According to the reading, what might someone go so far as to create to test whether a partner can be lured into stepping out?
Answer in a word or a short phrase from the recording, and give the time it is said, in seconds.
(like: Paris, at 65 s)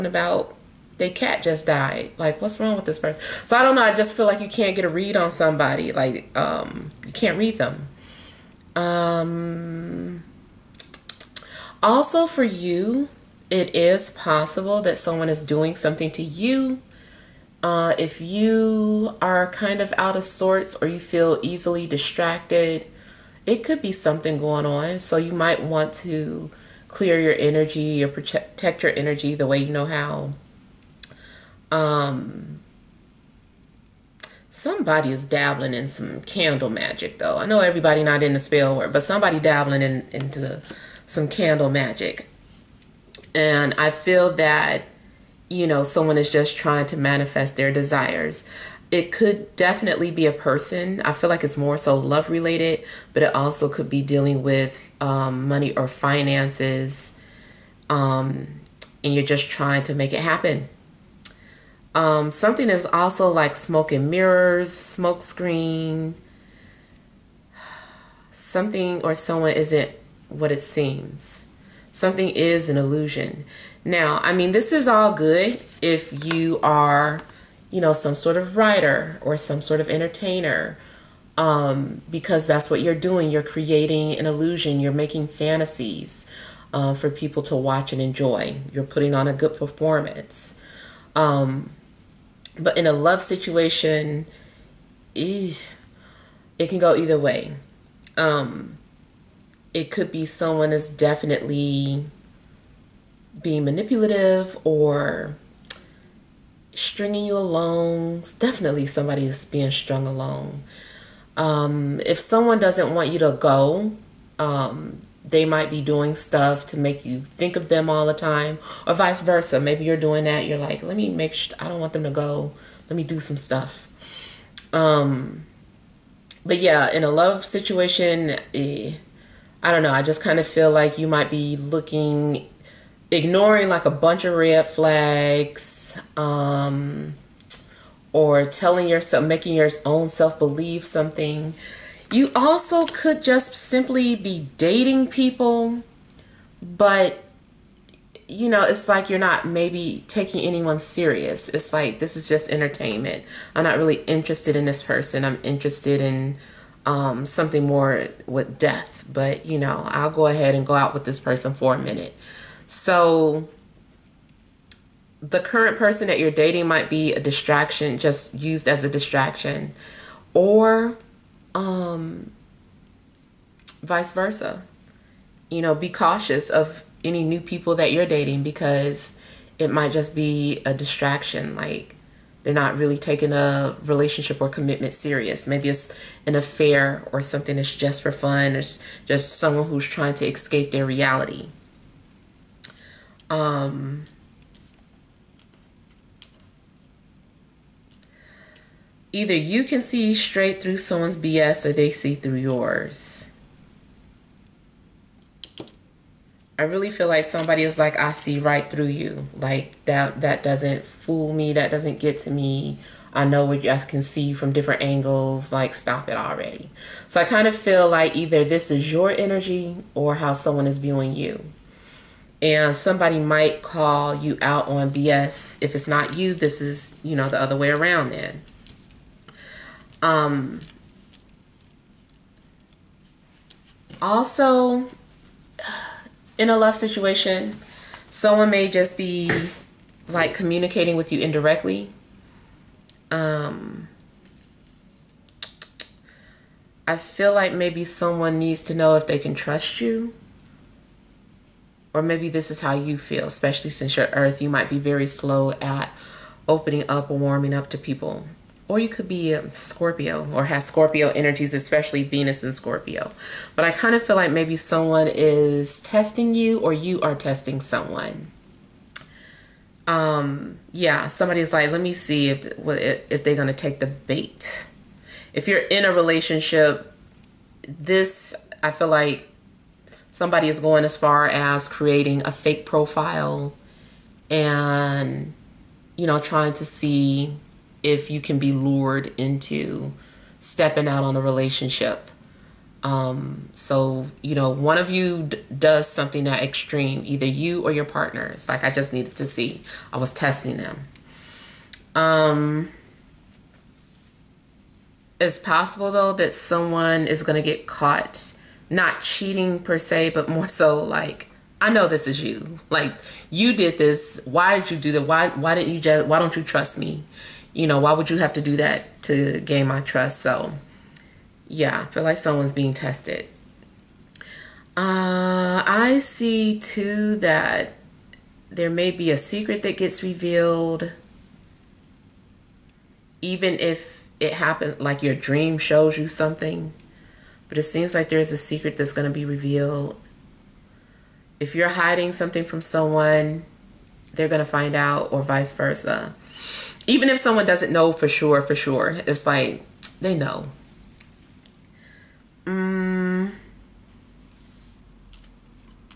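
A fake profile, at 282 s.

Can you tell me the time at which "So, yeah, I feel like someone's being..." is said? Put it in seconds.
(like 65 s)
320 s.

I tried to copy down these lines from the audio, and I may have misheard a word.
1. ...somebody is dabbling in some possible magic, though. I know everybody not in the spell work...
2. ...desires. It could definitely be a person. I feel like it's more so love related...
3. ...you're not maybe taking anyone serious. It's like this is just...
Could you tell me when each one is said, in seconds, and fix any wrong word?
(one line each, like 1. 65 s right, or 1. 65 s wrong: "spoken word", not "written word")
1. 34 s wrong: "candle", not "possible"
2. 47 s right
3. 149 s right.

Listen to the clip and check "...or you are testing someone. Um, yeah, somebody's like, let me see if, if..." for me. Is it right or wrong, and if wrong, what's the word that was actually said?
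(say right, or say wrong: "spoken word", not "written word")
right.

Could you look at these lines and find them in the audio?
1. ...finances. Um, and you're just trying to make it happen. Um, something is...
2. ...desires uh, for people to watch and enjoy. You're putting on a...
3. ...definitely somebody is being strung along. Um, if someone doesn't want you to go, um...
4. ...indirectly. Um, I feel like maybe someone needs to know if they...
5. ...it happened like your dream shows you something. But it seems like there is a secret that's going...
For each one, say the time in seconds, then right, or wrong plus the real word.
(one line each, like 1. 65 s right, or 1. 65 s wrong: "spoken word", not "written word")
1. 55 s right
2. 85 s wrong: "fantasies", not "desires"
3. 108 s right
4. 241 s right
5. 334 s right.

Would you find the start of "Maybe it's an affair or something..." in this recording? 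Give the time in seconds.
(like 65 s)
185 s.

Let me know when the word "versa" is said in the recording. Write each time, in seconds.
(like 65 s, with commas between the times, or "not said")
119 s, 174 s, 345 s.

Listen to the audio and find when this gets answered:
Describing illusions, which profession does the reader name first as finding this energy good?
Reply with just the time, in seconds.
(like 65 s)
78 s.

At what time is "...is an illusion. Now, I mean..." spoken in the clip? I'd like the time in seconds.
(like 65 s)
72 s.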